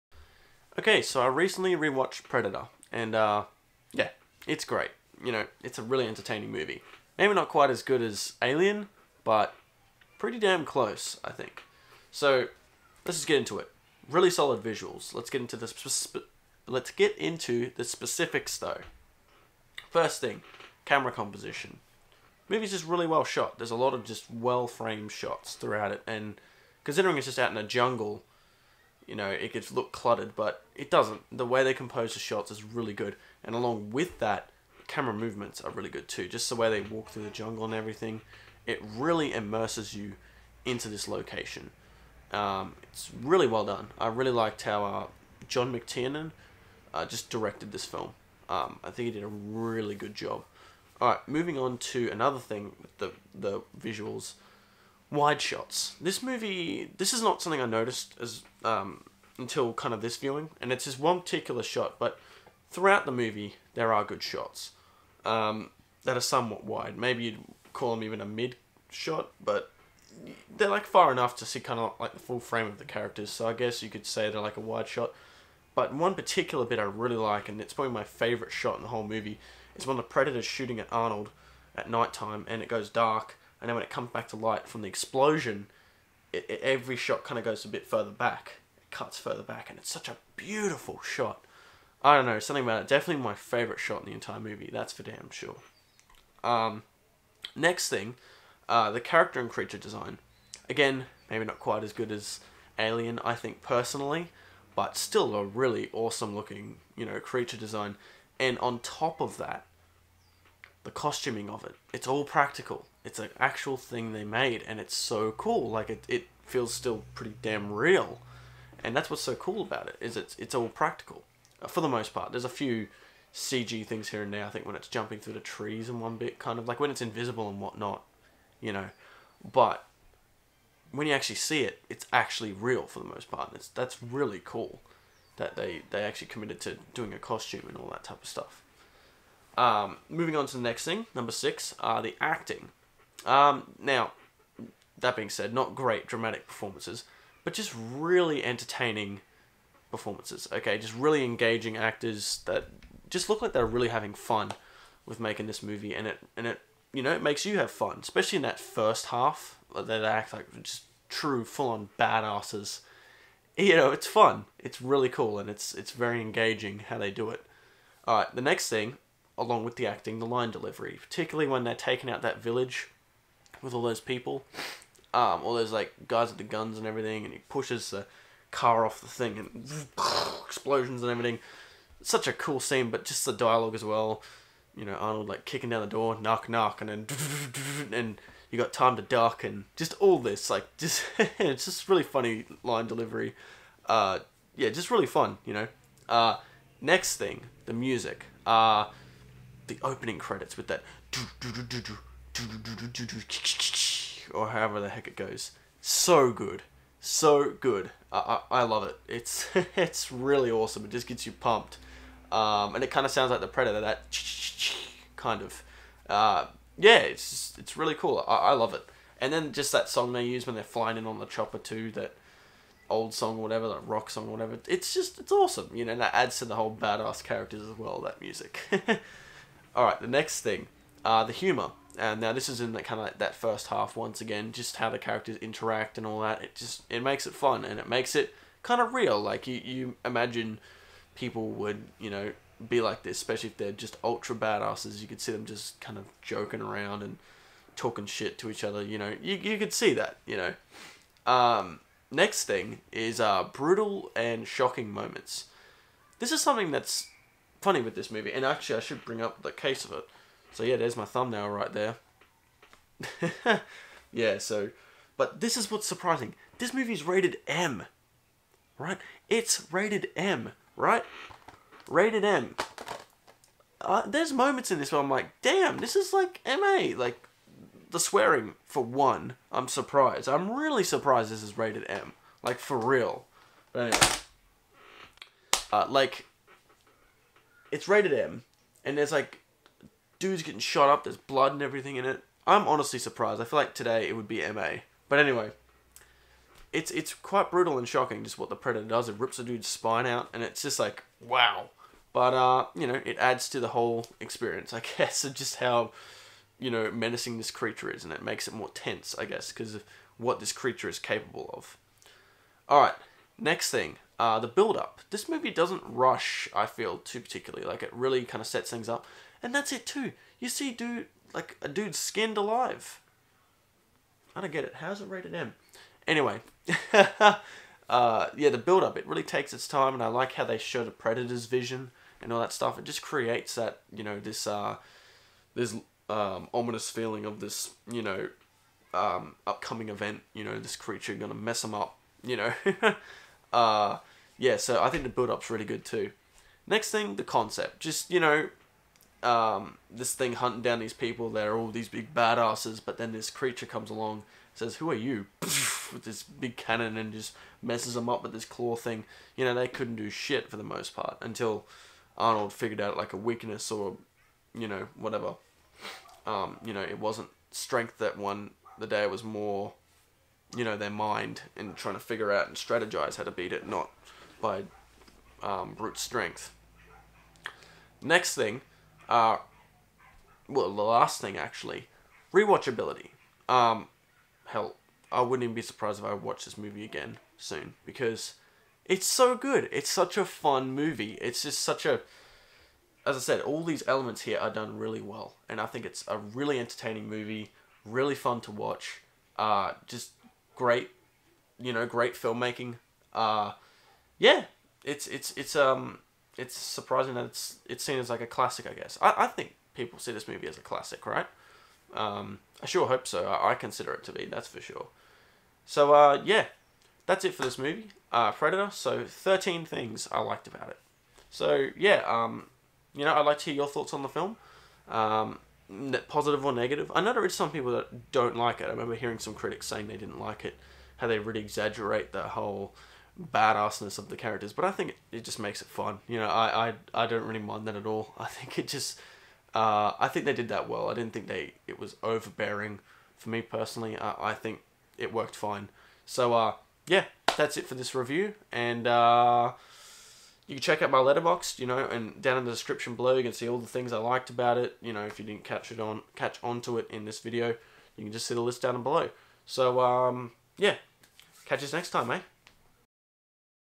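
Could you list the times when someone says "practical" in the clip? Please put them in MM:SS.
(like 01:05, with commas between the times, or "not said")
01:52, 02:00.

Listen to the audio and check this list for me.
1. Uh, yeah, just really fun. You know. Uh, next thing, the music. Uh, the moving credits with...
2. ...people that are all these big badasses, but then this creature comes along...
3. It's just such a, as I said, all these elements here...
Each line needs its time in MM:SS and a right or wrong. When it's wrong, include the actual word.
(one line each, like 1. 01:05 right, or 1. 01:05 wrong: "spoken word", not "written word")
1. 03:13 wrong: "opening", not "moving"
2. 05:50 right
3. 06:31 right.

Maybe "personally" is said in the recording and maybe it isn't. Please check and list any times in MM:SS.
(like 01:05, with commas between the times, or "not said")
01:43, 07:23.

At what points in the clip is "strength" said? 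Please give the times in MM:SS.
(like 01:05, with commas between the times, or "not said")
06:07, 06:15.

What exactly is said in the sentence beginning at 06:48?
I guess I, I think people see this movie as a classic, right?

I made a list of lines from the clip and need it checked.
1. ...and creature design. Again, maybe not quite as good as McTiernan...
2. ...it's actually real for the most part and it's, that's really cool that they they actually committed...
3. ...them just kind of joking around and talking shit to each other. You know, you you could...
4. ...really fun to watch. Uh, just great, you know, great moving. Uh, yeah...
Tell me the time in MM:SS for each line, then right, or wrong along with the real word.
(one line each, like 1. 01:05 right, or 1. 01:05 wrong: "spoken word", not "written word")
1. 01:39 wrong: "Alien", not "McTiernan"
2. 02:11 right
3. 04:05 right
4. 06:37 wrong: "filmmaking", not "moving".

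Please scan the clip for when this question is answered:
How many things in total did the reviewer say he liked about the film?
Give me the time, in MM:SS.
06:59.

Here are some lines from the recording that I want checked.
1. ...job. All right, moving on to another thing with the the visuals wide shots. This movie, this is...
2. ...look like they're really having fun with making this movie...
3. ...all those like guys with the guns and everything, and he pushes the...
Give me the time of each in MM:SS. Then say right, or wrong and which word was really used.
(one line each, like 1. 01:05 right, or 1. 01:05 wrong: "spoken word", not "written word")
1. 00:50 right
2. 02:33 right
3. 02:55 right.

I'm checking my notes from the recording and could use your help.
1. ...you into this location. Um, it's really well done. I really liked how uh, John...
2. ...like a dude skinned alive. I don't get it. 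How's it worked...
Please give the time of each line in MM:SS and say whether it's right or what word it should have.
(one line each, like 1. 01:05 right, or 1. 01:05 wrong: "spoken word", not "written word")
1. 00:39 right
2. 05:21 wrong: "rated", not "worked".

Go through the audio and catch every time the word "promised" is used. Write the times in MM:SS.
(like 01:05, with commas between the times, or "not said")
not said.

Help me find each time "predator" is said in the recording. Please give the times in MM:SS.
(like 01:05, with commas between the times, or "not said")
00:02, 01:20, 03:33, 04:58, 05:30, 06:58.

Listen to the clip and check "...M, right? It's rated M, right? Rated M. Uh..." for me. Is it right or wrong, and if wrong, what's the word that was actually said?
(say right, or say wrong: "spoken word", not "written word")
right.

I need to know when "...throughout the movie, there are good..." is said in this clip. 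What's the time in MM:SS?
01:02.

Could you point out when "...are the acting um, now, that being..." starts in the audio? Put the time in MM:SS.
02:21.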